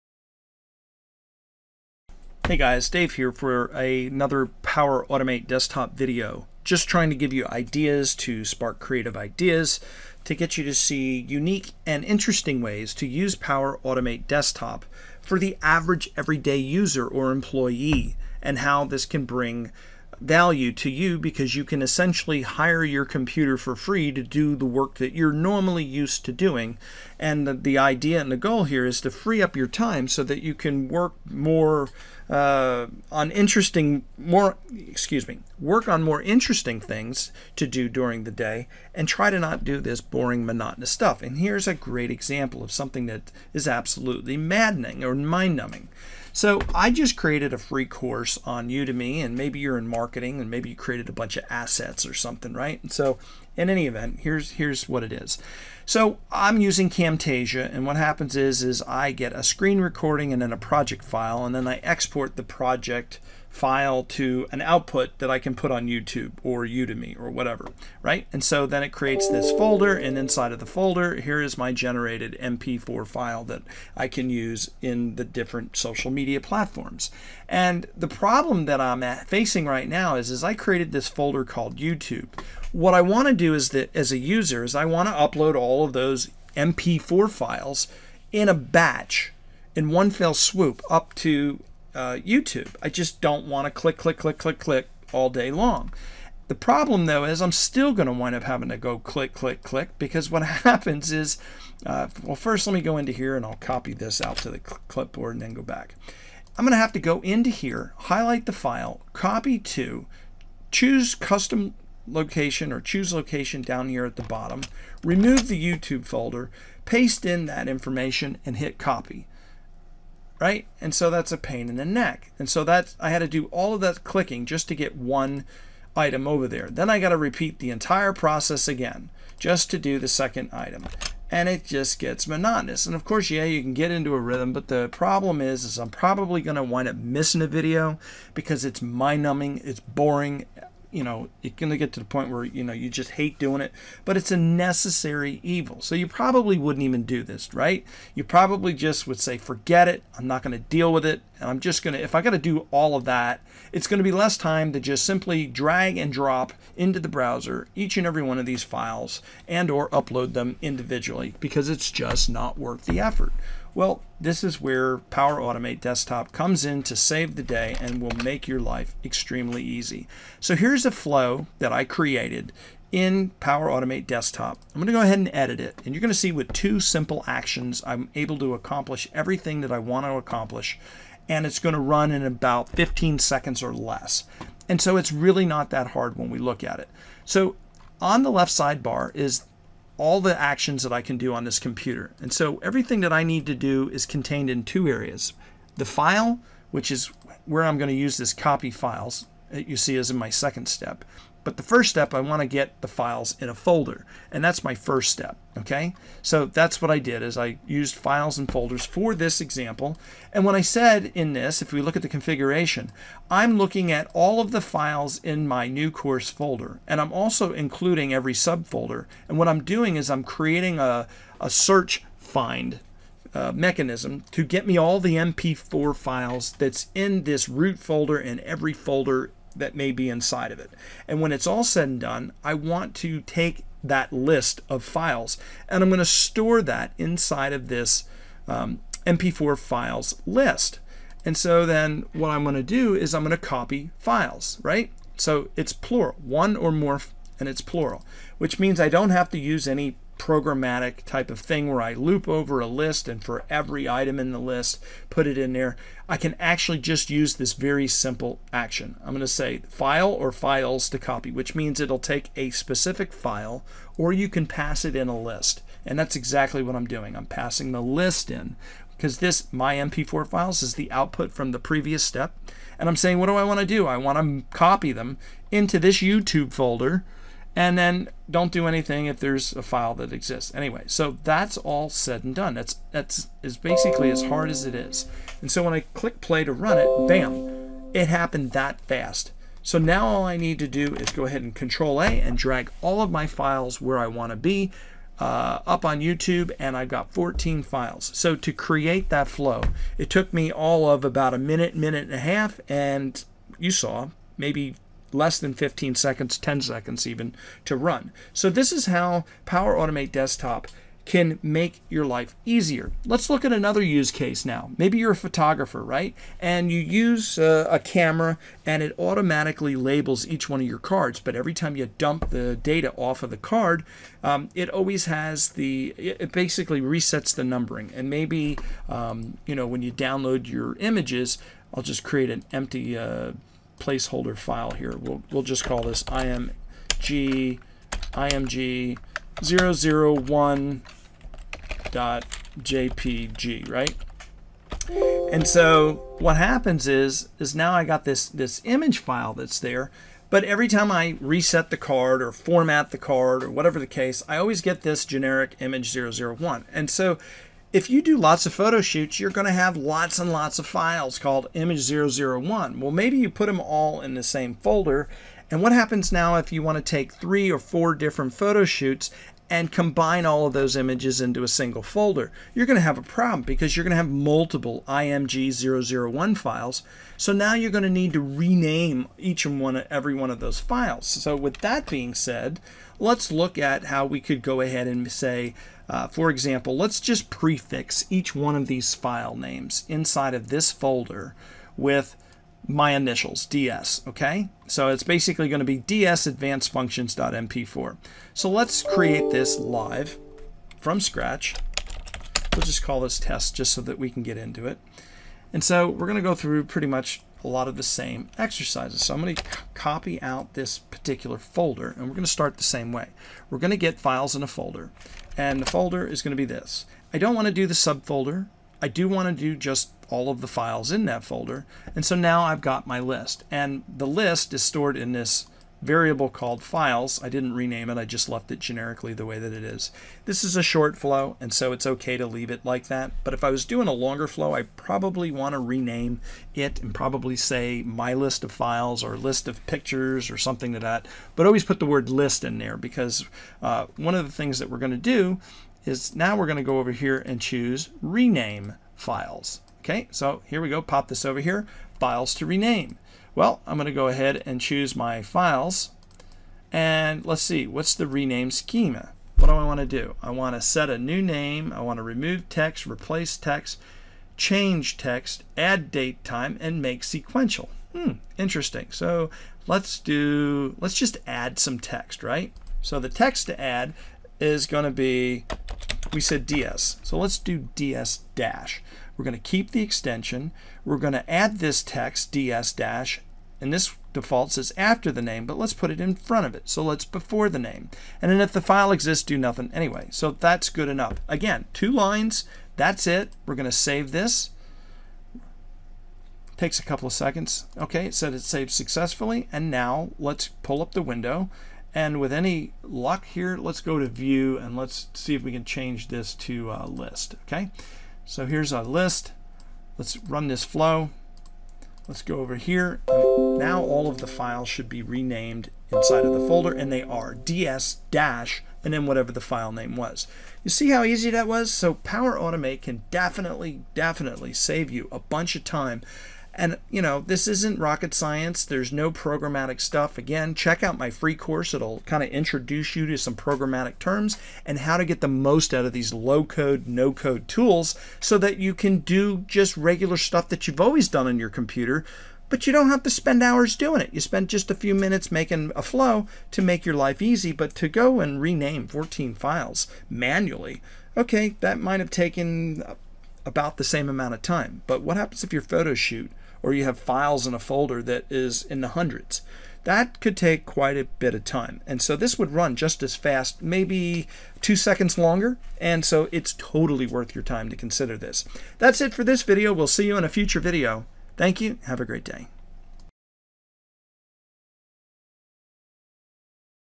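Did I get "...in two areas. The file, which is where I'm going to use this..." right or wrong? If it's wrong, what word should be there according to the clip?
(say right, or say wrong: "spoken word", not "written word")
right.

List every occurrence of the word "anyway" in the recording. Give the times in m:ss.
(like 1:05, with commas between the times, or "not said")
4:40, 8:09.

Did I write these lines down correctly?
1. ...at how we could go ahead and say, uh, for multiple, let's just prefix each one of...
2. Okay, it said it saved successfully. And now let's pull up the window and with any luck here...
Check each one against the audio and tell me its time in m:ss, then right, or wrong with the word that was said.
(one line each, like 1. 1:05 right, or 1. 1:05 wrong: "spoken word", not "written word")
1. 6:23 wrong: "example", not "multiple"
2. 8:17 right.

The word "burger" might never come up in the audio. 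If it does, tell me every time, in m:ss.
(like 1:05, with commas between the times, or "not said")
not said.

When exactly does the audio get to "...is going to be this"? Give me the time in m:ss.
6:56.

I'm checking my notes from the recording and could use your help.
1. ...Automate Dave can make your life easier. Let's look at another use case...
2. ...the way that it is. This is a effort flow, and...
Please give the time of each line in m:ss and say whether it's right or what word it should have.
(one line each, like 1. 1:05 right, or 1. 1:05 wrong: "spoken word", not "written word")
1. 5:09 wrong: "Desktop", not "Dave"
2. 7:09 wrong: "short", not "effort".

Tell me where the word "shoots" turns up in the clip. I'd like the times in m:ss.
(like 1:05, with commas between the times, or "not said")
5:58, 6:08, 9:15.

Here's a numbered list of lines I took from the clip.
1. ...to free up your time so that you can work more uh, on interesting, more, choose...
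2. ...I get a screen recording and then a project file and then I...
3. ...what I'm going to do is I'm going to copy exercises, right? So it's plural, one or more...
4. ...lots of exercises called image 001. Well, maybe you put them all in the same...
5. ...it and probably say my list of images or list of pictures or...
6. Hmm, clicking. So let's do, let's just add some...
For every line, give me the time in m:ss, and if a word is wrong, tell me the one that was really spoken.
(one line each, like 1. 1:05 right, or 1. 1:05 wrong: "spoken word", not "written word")
1. 0:29 wrong: "excuse", not "choose"
2. 0:58 right
3. 4:02 wrong: "files", not "exercises"
4. 6:00 wrong: "files", not "exercises"
5. 7:16 wrong: "files", not "images"
6. 7:47 wrong: "interesting", not "clicking".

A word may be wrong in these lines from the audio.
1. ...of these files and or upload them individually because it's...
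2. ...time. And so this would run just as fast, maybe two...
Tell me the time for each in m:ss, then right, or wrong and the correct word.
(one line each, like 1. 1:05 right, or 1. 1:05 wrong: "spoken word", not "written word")
1. 2:38 right
2. 9:21 right.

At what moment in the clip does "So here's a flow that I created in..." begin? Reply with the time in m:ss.
2:50.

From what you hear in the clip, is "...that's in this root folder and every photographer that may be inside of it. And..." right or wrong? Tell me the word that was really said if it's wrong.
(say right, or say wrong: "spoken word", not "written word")
wrong: "folder", not "photographer".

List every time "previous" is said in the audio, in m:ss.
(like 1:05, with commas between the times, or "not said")
4:31.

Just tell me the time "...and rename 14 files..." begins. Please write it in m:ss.
9:08.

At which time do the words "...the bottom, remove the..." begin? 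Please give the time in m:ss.
1:54.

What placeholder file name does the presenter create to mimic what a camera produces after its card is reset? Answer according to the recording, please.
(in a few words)
img 001.jpg.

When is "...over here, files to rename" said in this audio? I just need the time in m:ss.
7:31.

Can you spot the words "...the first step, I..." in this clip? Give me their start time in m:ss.
3:21.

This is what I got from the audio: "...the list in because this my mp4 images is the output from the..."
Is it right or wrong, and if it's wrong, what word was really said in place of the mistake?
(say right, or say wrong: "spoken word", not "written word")
wrong: "files", not "images".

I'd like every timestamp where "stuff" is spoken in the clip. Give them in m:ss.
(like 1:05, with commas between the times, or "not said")
0:40, 8:49, 9:00.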